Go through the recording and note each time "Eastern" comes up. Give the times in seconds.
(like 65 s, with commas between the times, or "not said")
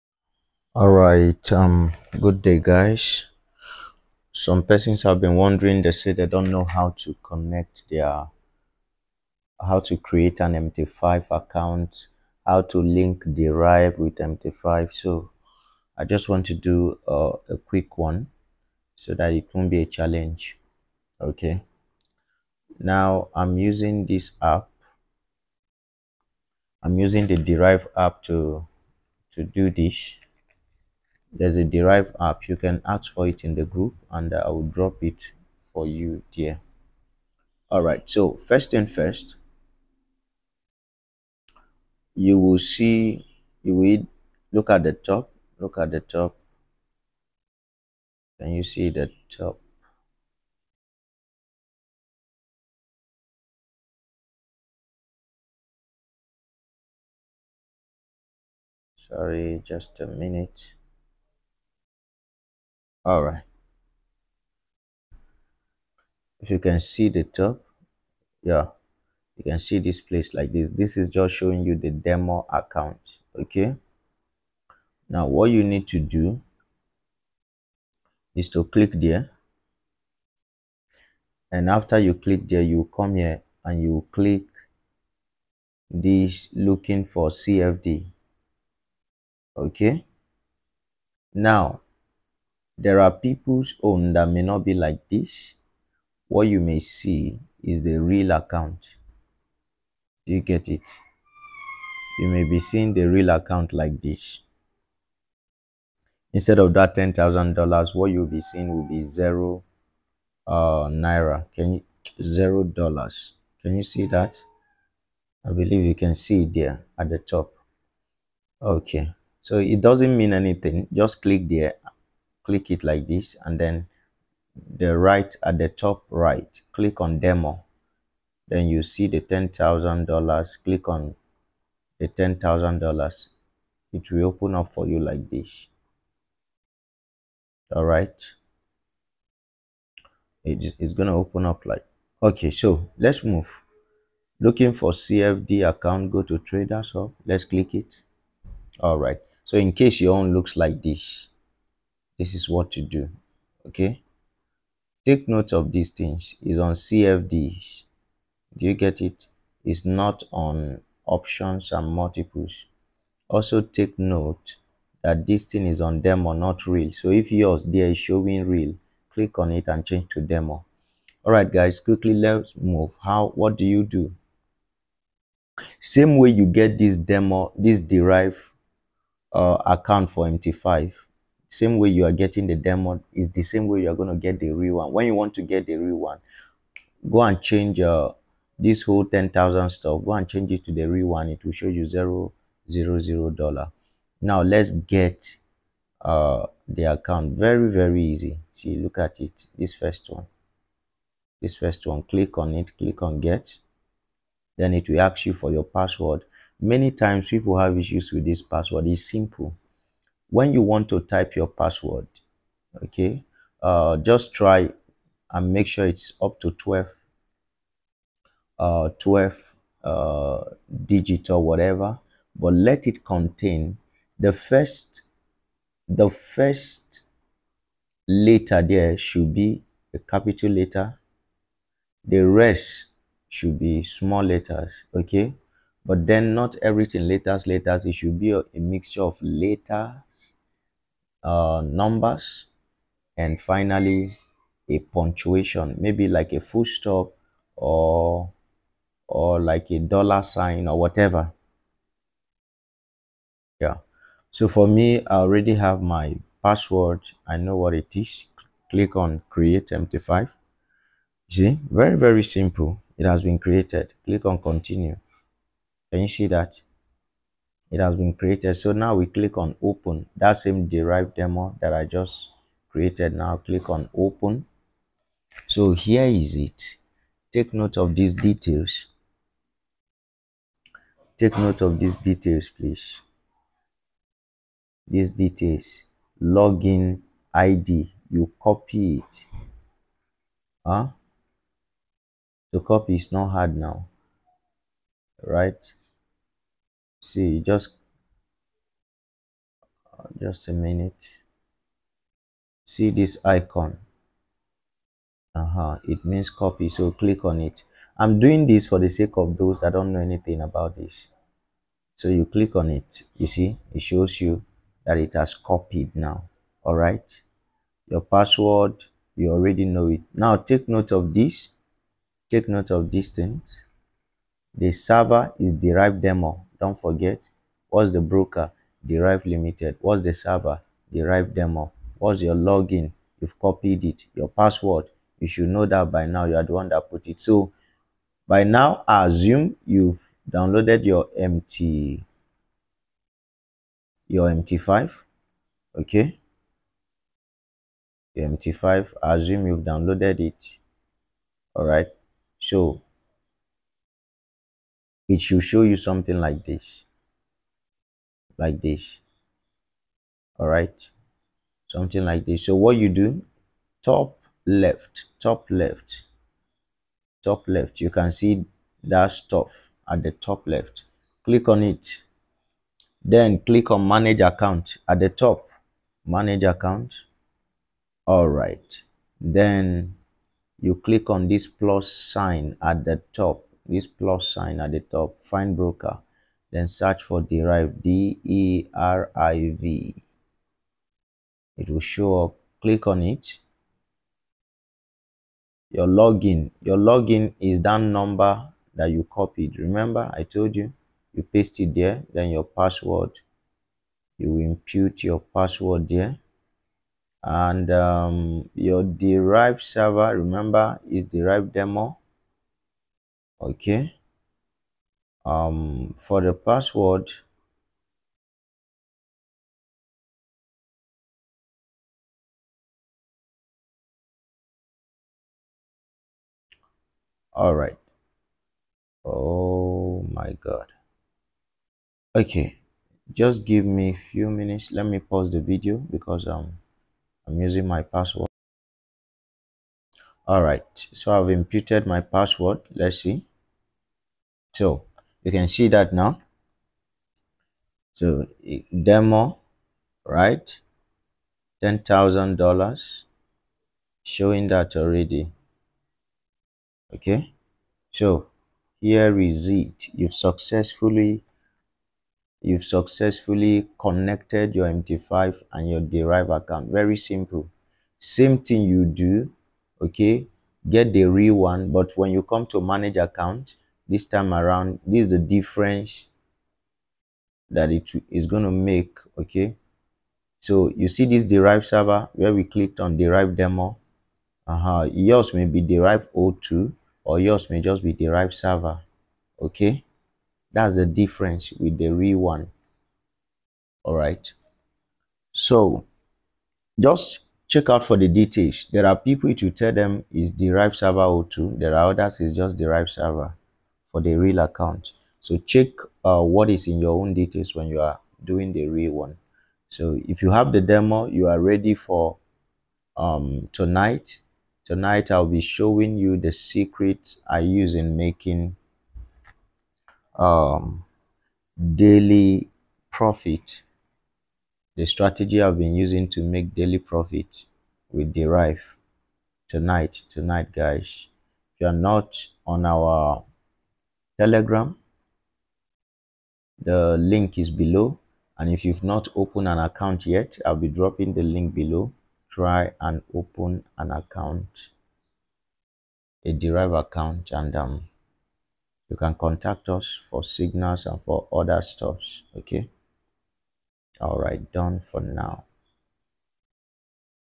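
not said.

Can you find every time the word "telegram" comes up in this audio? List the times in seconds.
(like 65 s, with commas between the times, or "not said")
534 s.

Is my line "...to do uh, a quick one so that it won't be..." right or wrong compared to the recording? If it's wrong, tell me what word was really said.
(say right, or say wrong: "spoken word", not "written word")
right.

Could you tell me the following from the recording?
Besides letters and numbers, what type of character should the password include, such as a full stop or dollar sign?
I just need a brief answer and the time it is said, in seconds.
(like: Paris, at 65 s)
punctuation, at 244 s.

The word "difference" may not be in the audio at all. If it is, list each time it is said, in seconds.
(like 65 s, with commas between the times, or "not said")
475 s, 490 s.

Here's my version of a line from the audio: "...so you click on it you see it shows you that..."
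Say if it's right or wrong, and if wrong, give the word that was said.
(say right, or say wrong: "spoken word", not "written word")
right.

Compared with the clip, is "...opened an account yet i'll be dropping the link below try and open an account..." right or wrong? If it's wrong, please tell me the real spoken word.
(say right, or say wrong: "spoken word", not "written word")
right.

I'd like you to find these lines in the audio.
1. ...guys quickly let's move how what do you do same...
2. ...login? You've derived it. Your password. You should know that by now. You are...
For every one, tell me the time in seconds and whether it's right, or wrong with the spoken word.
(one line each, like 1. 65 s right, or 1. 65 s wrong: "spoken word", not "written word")
1. 171 s right
2. 332 s wrong: "copied", not "derived".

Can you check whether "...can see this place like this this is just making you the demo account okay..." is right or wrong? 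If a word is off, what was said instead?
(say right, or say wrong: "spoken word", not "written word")
wrong: "showing", not "making".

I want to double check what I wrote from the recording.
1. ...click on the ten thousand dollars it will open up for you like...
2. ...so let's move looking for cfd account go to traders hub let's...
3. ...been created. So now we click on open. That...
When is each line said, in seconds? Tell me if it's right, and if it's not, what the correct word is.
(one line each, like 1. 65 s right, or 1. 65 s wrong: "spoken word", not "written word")
1. 130 s right
2. 142 s right
3. 267 s right.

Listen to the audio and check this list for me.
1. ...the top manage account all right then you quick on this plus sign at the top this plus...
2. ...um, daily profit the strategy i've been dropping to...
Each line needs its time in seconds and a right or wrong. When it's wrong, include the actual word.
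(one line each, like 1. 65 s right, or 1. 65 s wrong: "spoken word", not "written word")
1. 374 s wrong: "click", not "quick"
2. 520 s wrong: "using", not "dropping".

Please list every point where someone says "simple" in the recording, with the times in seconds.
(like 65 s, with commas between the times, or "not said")
209 s, 262 s, 466 s.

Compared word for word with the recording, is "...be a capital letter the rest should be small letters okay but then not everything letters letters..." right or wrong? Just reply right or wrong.
right.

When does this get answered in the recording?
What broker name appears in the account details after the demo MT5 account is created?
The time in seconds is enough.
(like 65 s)
328 s.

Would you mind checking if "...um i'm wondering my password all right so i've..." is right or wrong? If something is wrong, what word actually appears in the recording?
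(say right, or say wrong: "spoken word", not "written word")
wrong: "using", not "wondering".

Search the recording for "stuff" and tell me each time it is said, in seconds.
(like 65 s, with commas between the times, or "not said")
189 s, 369 s, 551 s.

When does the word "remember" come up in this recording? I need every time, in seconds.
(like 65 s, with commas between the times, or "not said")
399 s, 410 s.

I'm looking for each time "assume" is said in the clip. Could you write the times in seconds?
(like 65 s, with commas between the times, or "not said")
339 s, 349 s.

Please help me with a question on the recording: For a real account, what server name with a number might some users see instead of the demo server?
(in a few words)
Deriv 02.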